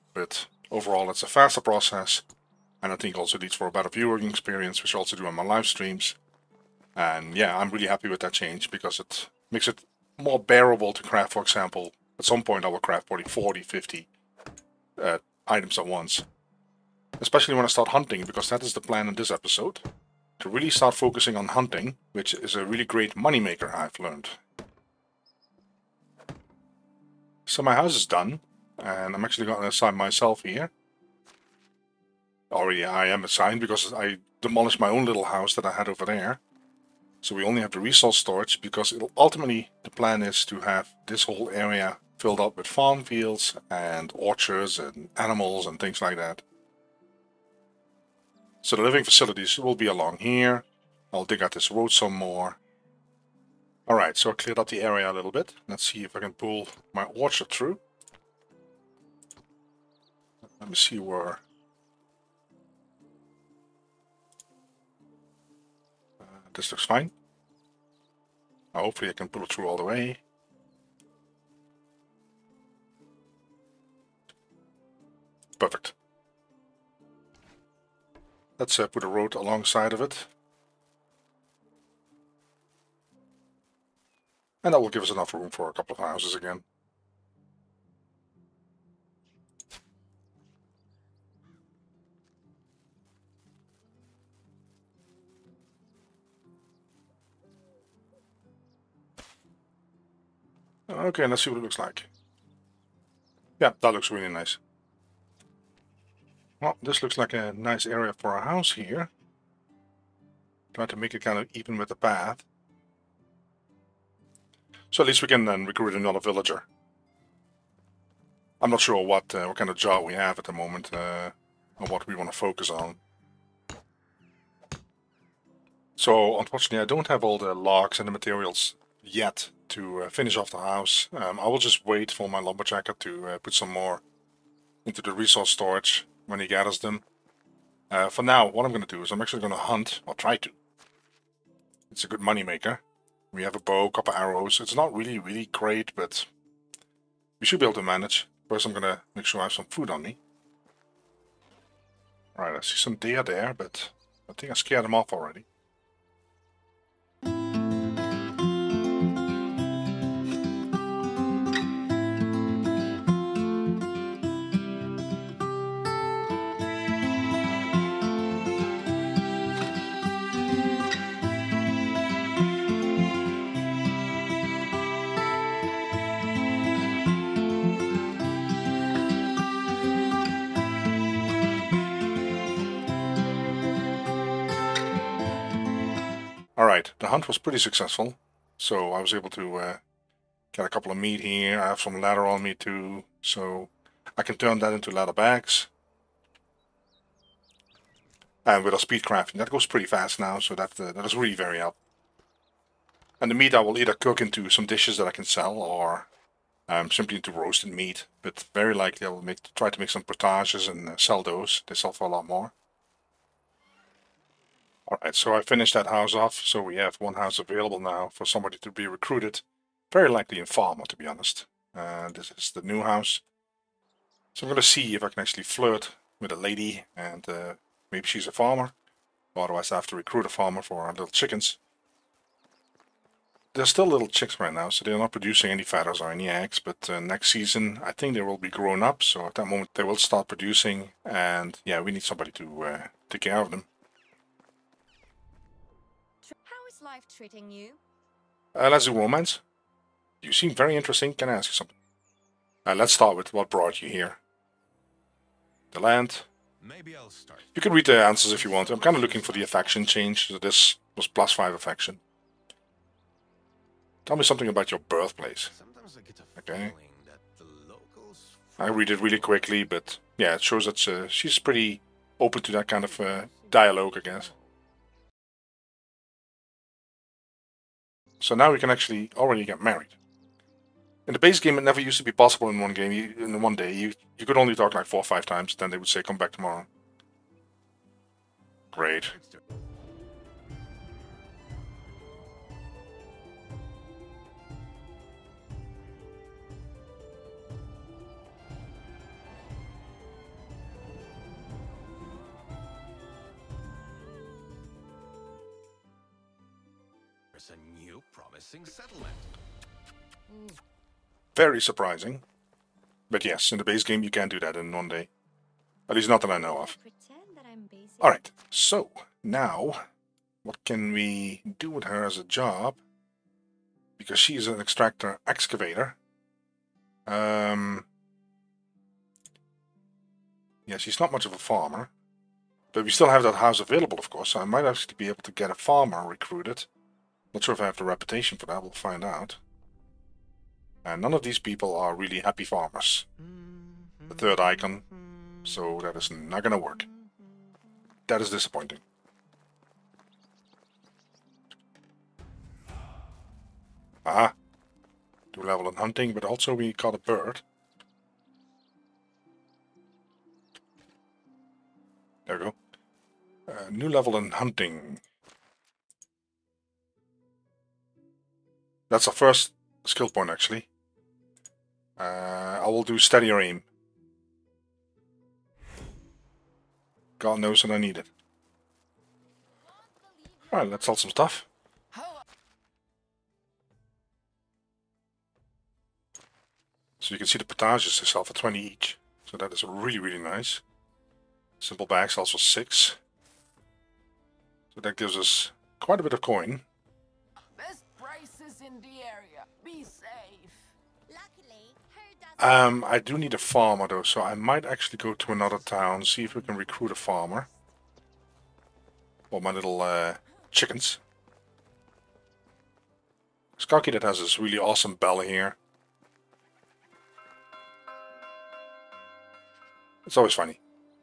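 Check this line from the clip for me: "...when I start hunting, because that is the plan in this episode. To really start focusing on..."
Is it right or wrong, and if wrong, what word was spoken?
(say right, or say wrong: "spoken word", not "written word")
right.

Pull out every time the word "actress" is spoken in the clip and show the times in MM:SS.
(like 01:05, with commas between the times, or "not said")
not said.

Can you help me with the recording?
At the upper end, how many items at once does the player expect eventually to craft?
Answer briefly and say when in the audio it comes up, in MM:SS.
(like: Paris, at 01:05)
50, at 00:13.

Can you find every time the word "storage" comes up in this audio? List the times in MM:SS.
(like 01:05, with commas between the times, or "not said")
00:38, 02:15.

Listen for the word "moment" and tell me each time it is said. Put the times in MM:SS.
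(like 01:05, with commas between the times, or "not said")
02:00, 03:59.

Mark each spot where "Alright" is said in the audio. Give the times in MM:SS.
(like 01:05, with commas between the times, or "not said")
05:18, 06:20.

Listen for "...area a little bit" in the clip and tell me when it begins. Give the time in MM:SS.
00:54.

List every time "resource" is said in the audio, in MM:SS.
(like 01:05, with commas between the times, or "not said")
00:37, 02:15.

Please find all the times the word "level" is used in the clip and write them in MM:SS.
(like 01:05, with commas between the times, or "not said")
05:55, 06:03.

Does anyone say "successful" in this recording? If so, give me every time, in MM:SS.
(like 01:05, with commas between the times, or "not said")
03:07.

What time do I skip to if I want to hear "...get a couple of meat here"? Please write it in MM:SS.
03:10.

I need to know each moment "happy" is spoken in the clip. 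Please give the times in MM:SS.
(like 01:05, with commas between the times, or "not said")
00:07, 05:42.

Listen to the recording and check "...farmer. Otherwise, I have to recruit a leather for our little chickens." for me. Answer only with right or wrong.
wrong.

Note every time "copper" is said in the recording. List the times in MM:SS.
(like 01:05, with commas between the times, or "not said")
02:23.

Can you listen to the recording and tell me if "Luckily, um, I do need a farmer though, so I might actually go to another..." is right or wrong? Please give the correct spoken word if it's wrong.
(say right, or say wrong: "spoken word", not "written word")
right.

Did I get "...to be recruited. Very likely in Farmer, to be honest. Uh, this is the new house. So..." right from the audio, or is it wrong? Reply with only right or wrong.
right.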